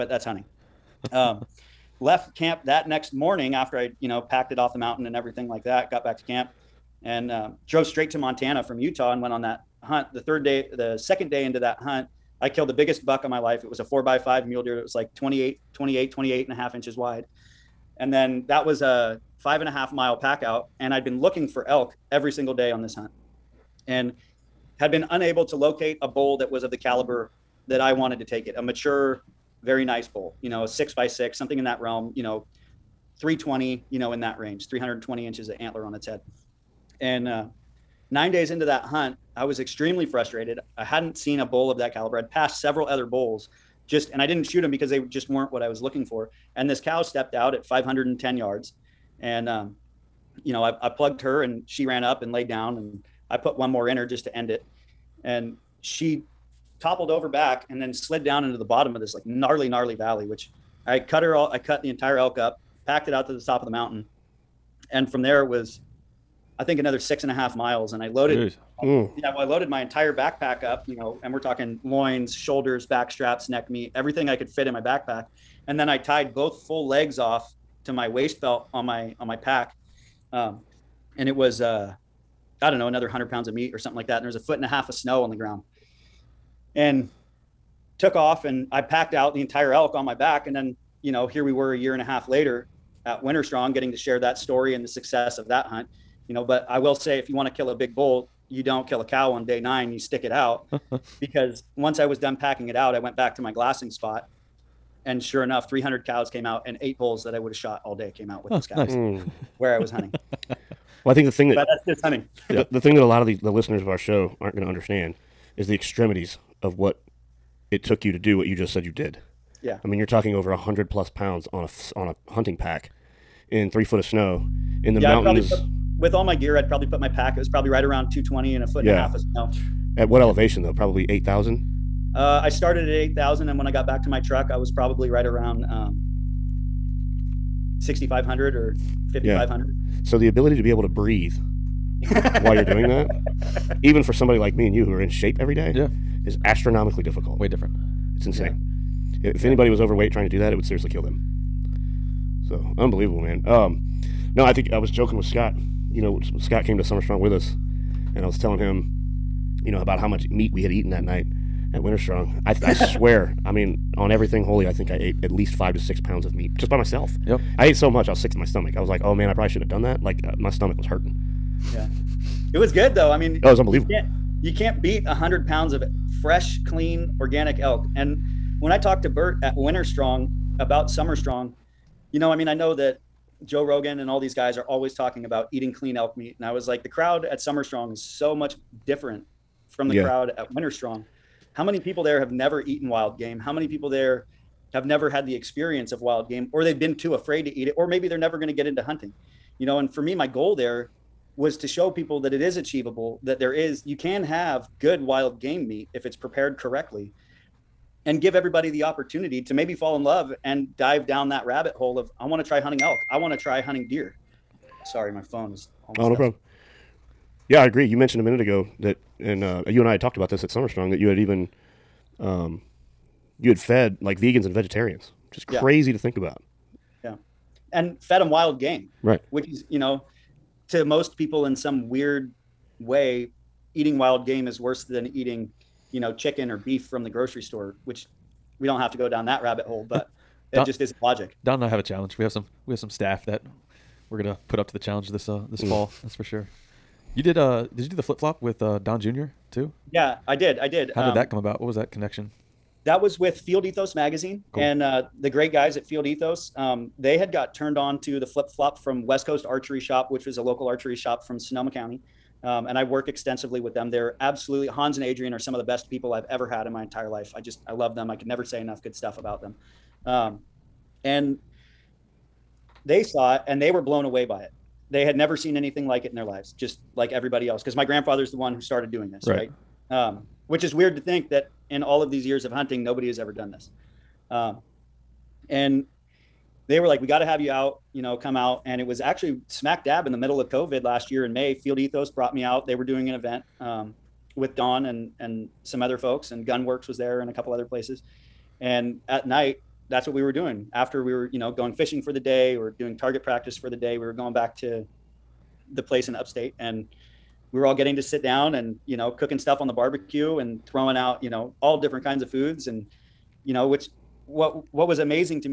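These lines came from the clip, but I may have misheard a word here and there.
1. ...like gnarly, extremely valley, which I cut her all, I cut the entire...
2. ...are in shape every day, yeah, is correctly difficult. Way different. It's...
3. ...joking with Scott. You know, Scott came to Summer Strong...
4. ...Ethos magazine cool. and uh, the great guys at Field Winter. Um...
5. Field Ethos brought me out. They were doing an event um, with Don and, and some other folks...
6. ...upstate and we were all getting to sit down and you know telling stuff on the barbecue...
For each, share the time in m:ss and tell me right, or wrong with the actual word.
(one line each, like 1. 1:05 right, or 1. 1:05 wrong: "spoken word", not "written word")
1. 0:59 wrong: "gnarly", not "extremely"
2. 2:24 wrong: "astronomically", not "correctly"
3. 2:34 right
4. 4:13 wrong: "Ethos", not "Winter"
5. 4:51 right
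6. 5:06 wrong: "cooking", not "telling".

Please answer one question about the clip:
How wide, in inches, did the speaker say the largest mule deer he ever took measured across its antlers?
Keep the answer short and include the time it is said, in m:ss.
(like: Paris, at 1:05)
28 and a half inches, at 0:16.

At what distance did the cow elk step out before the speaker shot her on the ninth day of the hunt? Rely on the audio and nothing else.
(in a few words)
510 yards.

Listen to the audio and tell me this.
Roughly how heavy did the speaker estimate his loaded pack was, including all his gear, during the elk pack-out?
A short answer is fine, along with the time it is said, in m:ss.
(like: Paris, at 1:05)
220 pounds, at 2:07.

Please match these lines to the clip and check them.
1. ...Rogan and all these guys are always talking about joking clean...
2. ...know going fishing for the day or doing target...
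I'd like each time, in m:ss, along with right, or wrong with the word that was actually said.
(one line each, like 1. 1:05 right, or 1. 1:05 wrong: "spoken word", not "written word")
1. 3:03 wrong: "eating", not "joking"
2. 5:01 right.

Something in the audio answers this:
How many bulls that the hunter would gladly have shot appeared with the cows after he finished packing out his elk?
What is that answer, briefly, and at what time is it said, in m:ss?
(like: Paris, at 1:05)
8, at 1:46.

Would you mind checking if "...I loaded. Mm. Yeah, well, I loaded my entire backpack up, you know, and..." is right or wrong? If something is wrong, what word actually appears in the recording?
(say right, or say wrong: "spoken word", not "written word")
right.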